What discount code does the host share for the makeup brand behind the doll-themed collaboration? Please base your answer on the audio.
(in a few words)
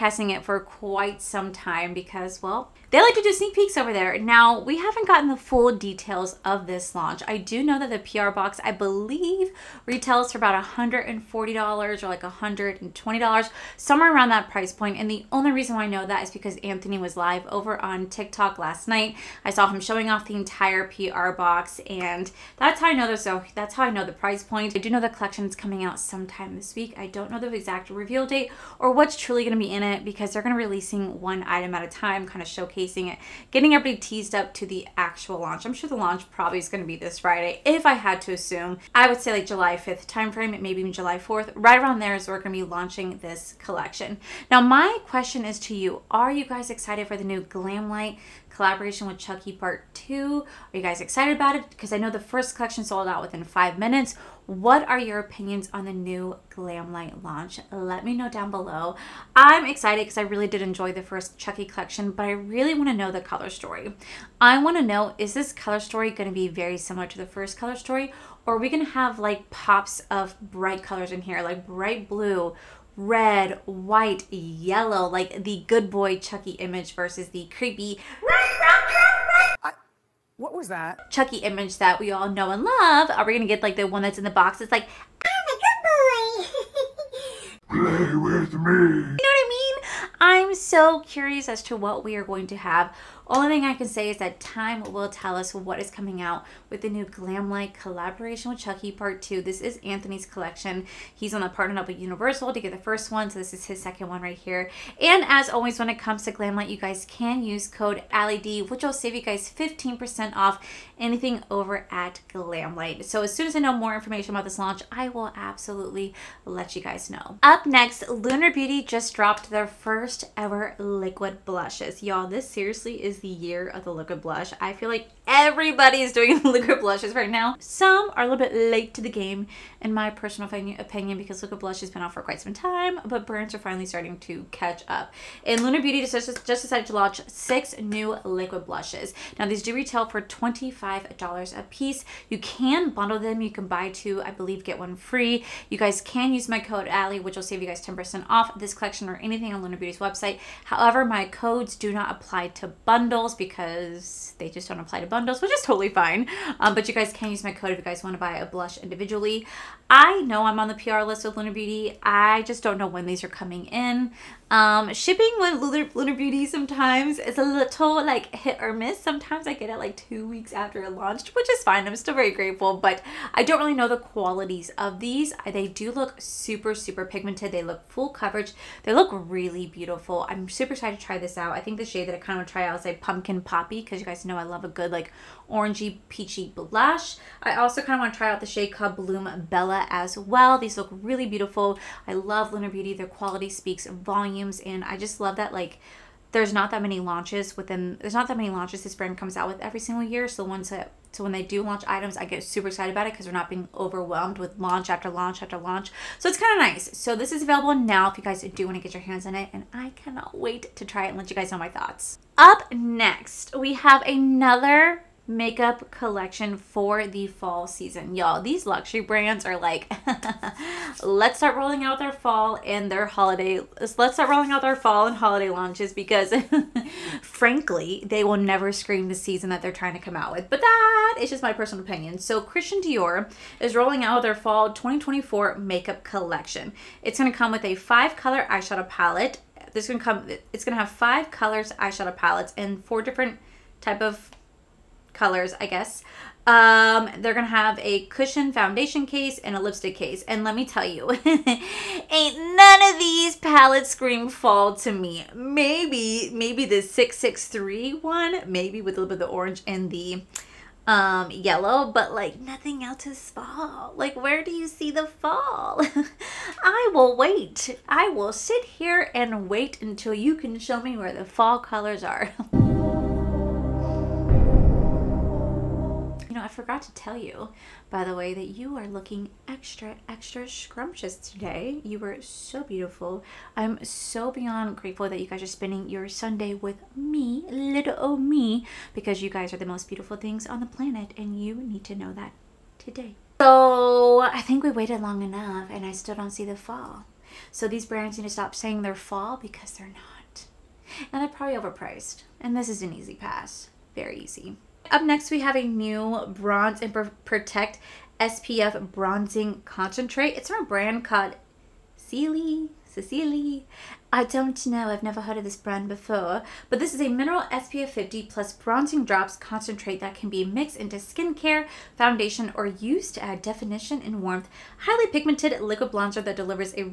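AllieD.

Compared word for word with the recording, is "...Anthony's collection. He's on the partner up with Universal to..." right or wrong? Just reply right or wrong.
right.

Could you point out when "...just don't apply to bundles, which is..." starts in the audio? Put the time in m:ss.
2:34.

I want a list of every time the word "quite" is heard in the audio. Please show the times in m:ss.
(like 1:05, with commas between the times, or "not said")
0:00, 2:12.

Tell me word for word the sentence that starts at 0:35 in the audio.
I'm sure the launch probably is going to be this Friday, if I had to assume.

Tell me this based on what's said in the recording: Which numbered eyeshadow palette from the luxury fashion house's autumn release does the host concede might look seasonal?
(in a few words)
663.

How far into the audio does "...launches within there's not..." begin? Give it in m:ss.
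3:17.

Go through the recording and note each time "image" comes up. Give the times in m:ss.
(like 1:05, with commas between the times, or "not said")
1:16, 1:21.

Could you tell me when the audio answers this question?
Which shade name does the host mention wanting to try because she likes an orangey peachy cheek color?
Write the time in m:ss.
3:03.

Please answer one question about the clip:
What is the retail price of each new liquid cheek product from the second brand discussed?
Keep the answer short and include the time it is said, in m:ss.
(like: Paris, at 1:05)
$25, at 2:20.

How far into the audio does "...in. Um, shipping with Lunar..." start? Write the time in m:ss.
2:43.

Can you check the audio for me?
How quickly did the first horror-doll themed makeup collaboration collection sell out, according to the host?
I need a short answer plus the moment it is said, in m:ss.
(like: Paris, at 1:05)
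5 minutes, at 0:53.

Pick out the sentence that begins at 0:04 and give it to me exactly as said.
Now, we haven't gotten the full details of this launch.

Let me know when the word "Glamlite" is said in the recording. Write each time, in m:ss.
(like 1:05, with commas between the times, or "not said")
0:47, 0:56, 1:37, 1:46, 1:52.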